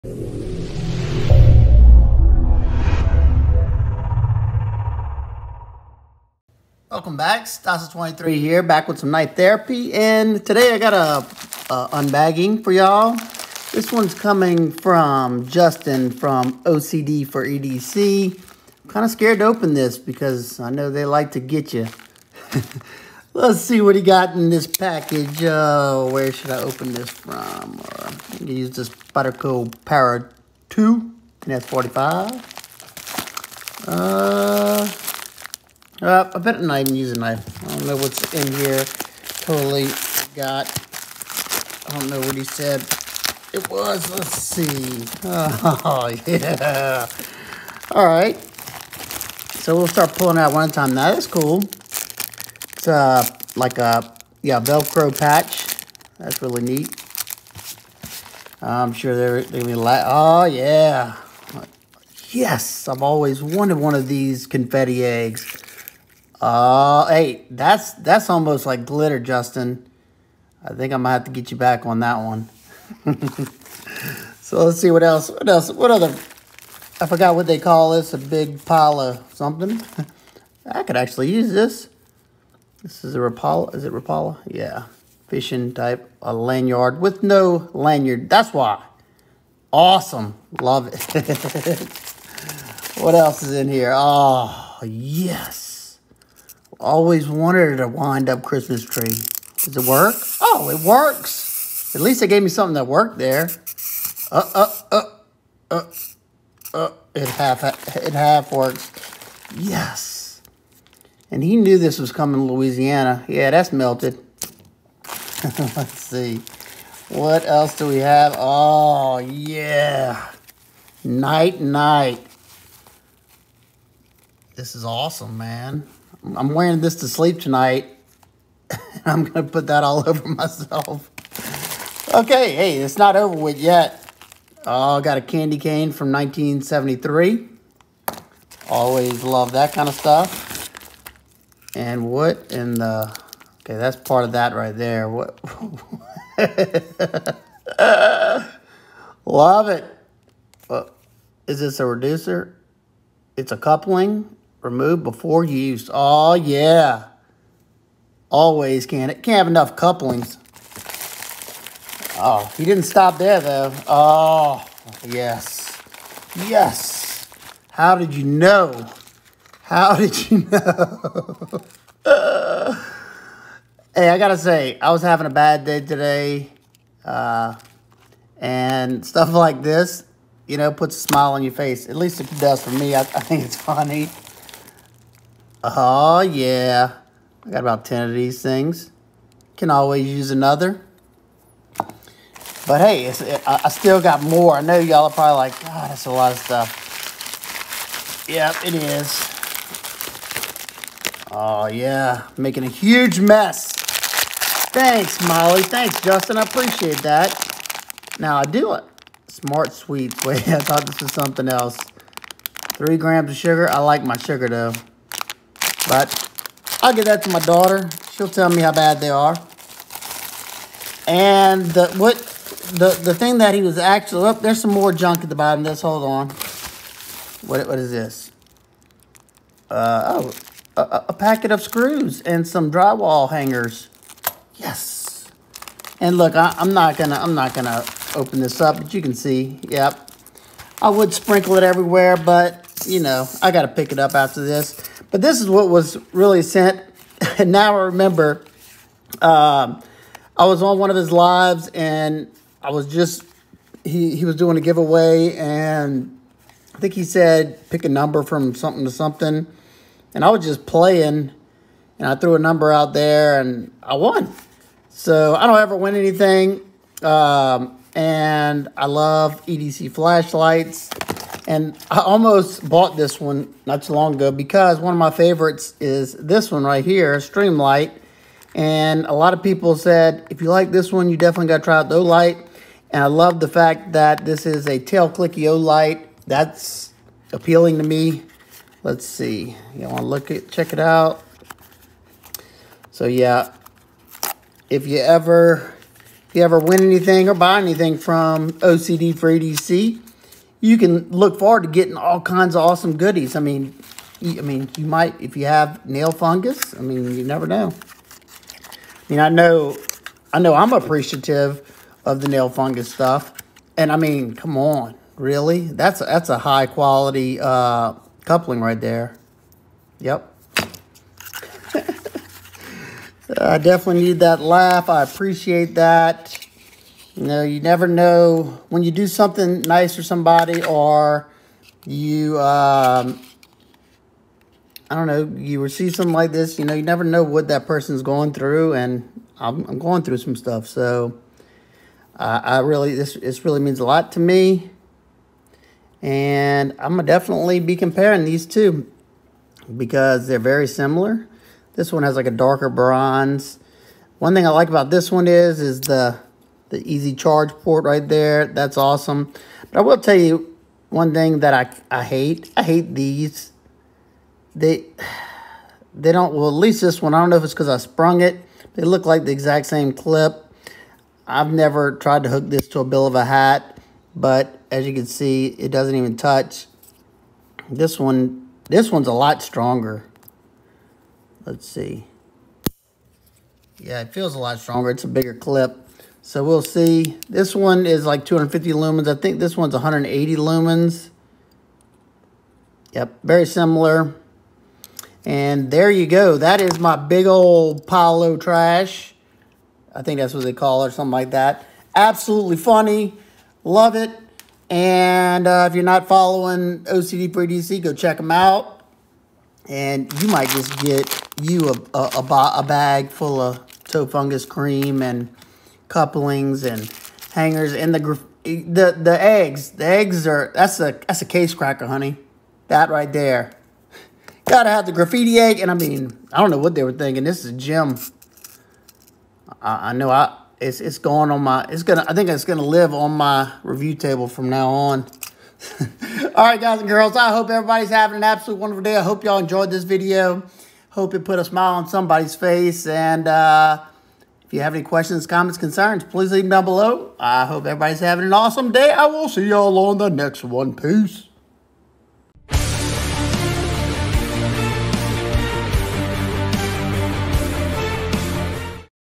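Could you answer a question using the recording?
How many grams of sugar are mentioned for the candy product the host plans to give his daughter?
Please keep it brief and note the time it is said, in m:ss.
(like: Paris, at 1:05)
3 grams, at 3:32.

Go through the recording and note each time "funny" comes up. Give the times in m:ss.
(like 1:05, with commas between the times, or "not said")
3:03, 6:42.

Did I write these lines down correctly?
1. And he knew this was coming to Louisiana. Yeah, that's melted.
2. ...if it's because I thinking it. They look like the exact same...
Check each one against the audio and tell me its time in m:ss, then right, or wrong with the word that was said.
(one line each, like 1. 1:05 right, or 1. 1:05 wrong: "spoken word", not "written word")
1. 1:51 right
2. 6:07 wrong: "sprung", not "thinking".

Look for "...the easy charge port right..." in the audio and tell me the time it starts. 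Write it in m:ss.
5:56.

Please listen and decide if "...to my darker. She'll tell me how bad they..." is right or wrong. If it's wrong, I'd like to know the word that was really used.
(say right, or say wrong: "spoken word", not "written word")
wrong: "daughter", not "darker".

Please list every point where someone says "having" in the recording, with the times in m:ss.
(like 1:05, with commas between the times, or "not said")
2:55, 7:17, 7:28.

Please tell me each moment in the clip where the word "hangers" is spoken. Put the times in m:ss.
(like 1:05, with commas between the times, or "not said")
3:53, 6:57.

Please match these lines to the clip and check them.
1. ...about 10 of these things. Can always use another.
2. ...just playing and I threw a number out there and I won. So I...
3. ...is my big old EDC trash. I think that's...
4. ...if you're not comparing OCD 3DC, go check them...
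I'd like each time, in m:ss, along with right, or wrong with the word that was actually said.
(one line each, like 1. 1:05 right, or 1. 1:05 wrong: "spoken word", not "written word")
1. 3:07 right
2. 4:20 right
3. 6:36 wrong: "Palo", not "EDC"
4. 6:45 wrong: "following", not "comparing".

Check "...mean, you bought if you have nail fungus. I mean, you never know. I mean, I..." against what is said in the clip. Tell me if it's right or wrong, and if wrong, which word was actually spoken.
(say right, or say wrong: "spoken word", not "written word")
wrong: "might", not "bought".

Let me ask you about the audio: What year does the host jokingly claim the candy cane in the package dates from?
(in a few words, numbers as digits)
1973.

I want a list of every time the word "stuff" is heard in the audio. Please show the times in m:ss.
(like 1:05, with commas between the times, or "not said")
2:19, 2:59, 3:16, 5:12, 5:40.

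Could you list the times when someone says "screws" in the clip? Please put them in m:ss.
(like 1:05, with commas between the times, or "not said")
3:51.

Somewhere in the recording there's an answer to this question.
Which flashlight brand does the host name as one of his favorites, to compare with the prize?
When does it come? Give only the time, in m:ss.
4:37.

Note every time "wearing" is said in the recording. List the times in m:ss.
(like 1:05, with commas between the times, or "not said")
2:06.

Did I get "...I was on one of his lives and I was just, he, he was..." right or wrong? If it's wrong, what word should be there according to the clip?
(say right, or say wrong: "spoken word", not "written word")
right.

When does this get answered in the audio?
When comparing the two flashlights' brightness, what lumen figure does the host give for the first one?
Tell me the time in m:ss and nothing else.
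6:28.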